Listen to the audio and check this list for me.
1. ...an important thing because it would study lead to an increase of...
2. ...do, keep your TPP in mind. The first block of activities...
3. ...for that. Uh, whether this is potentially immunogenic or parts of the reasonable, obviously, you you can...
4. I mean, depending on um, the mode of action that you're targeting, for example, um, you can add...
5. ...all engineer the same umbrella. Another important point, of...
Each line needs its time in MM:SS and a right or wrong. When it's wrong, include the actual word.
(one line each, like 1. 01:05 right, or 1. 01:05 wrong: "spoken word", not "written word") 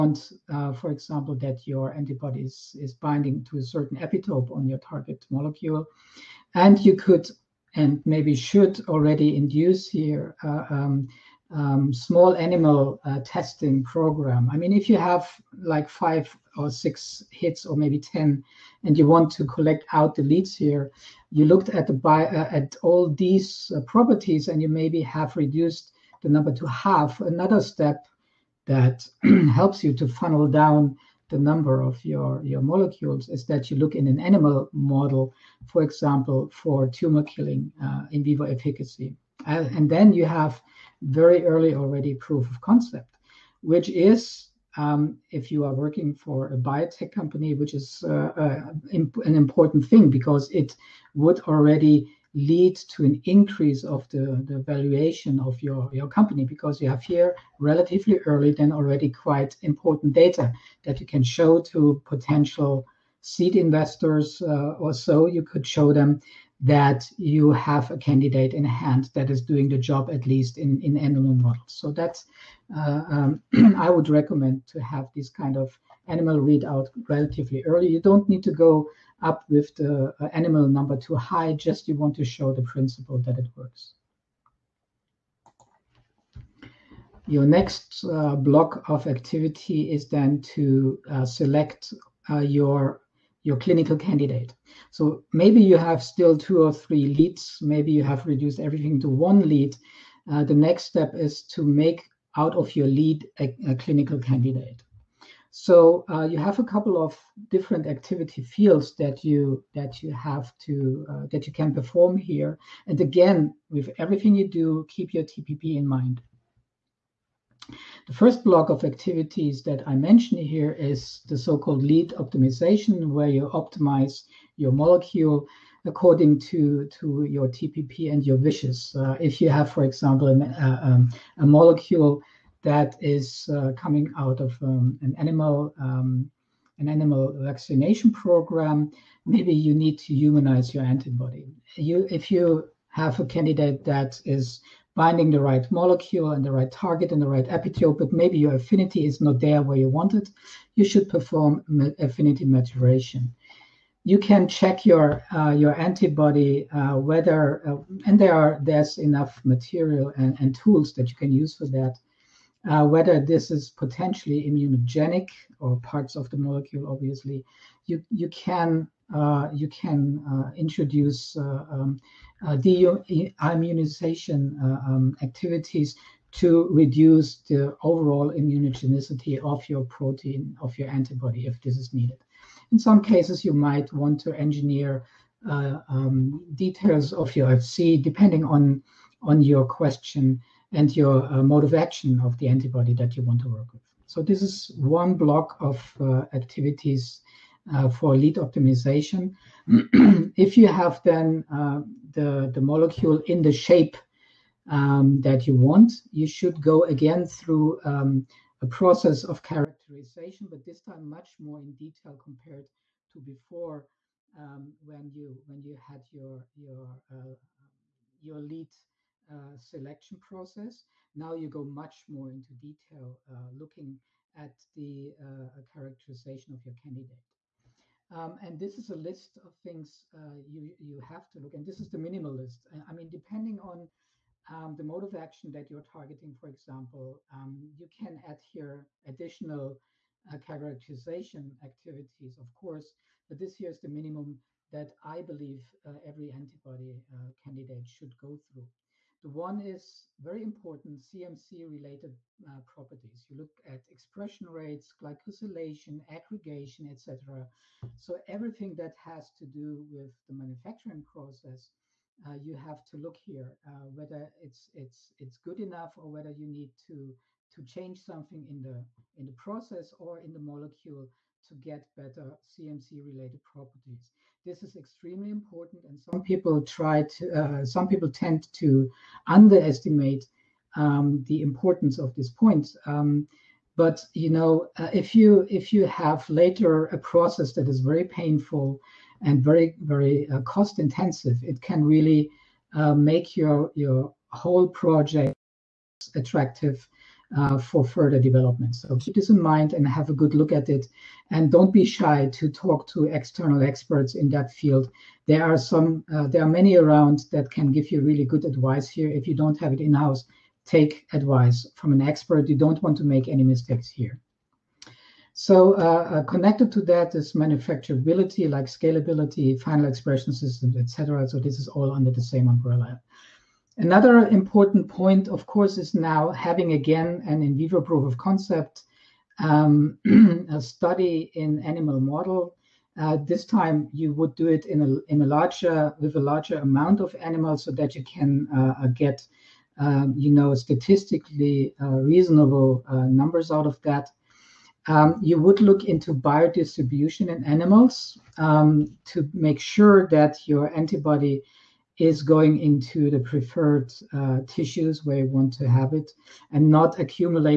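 1. 00:49 wrong: "already", not "study"
2. 01:54 right
3. 02:41 wrong: "molecule", not "reasonable"
4. 03:52 right
5. 05:21 wrong: "under", not "engineer".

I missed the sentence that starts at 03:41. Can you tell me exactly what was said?
Now you go much more into detail, uh, looking at the uh, characterization of your candidate.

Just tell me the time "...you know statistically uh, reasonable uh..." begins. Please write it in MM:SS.
05:40.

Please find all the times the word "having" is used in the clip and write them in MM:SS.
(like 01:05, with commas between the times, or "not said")
05:26.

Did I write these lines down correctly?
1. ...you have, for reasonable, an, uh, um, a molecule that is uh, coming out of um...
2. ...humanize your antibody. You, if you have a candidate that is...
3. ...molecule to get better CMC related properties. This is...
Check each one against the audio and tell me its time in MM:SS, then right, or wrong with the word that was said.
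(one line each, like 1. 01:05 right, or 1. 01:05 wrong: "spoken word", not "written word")
1. 02:09 wrong: "example", not "reasonable"
2. 02:20 right
3. 04:30 right.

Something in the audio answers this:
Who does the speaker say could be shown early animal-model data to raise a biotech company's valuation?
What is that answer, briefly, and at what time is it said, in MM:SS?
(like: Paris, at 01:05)
Seed investors, at 01:03.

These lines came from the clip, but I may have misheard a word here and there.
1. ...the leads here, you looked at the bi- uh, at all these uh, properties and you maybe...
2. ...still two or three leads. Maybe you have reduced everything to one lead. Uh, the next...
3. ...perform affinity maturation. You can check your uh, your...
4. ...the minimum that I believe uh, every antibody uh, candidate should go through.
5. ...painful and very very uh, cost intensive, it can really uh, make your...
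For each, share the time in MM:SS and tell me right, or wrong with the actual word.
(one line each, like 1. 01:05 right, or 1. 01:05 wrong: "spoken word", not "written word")
1. 00:20 right
2. 01:36 right
3. 02:31 right
4. 04:03 right
5. 04:48 right.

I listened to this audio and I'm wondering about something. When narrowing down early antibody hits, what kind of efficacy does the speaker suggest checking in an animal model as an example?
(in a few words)
Tumor killing.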